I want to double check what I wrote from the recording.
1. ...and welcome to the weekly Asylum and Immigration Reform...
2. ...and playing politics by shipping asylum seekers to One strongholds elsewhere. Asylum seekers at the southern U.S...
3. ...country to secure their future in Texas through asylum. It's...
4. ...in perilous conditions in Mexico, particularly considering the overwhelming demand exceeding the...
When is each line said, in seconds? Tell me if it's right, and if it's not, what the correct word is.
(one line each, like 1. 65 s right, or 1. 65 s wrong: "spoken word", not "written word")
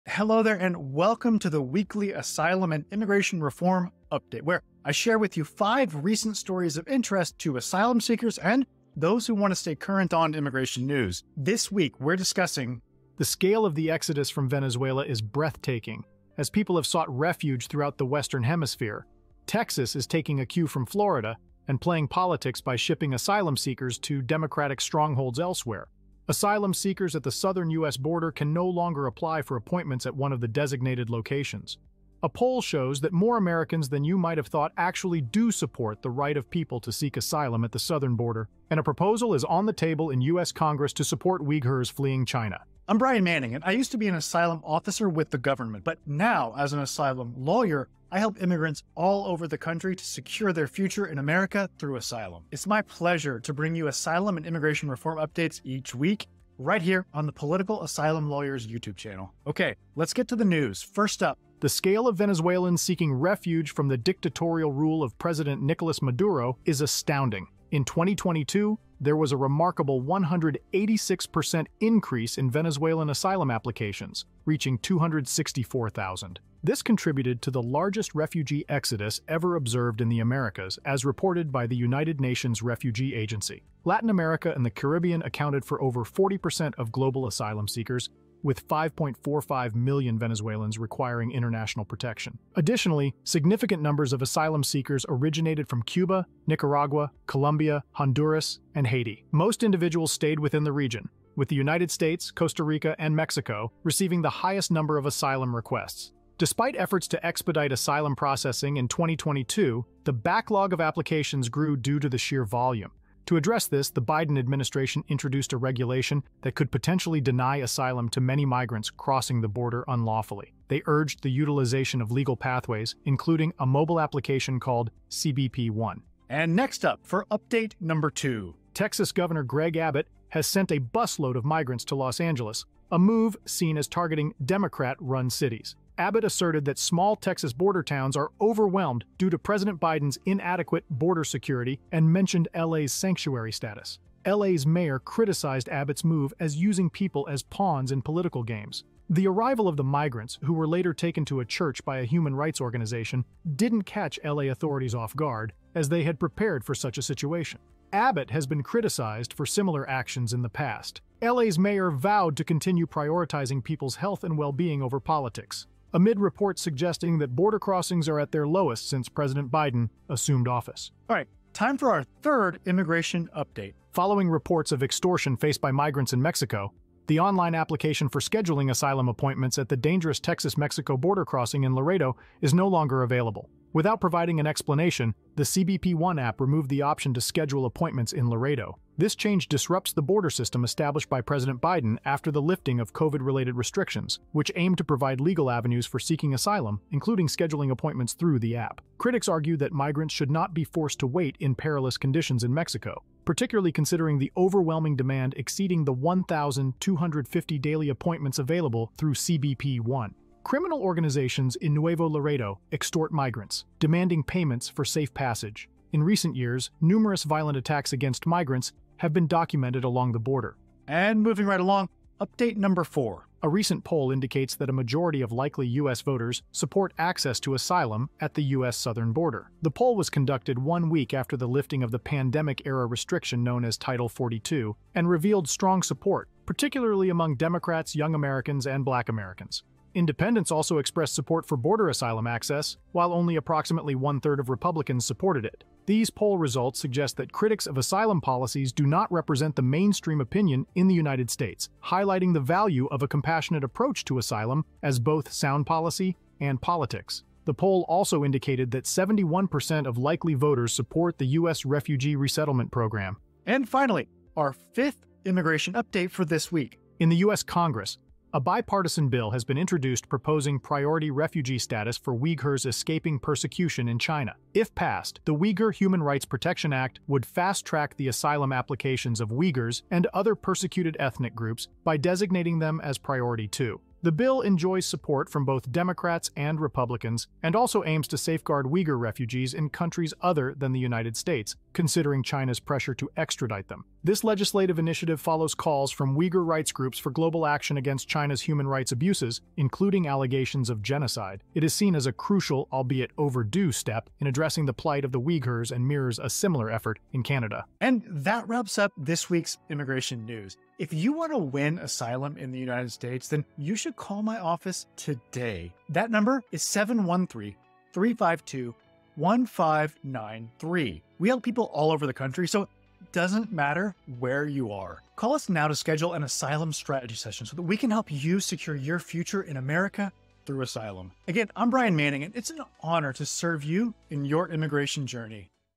1. 0 s right
2. 21 s wrong: "Democratic", not "One"
3. 49 s wrong: "America", not "Texas"
4. 201 s right.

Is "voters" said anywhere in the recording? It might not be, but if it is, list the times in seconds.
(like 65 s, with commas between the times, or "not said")
226 s, 260 s.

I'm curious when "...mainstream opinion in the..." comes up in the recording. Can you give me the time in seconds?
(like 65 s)
249 s.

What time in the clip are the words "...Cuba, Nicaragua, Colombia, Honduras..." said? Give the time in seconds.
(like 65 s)
95 s.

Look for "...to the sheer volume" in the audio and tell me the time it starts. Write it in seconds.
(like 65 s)
111 s.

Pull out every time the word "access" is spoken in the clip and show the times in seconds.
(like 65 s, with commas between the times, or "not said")
226 s, 242 s.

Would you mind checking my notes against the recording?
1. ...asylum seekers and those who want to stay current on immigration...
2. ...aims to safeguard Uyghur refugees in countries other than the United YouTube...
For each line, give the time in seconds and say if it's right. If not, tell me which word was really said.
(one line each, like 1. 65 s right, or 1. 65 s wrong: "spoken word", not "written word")
1. 7 s right
2. 287 s wrong: "States", not "YouTube".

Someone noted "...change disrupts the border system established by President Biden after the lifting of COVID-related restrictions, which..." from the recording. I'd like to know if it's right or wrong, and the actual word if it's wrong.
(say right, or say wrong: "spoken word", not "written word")
right.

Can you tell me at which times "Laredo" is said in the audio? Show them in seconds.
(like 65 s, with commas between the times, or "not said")
181 s, 188 s, 212 s.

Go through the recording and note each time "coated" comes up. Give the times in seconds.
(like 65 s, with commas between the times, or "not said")
not said.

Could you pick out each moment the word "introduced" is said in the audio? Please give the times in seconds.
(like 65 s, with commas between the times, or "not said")
115 s, 269 s.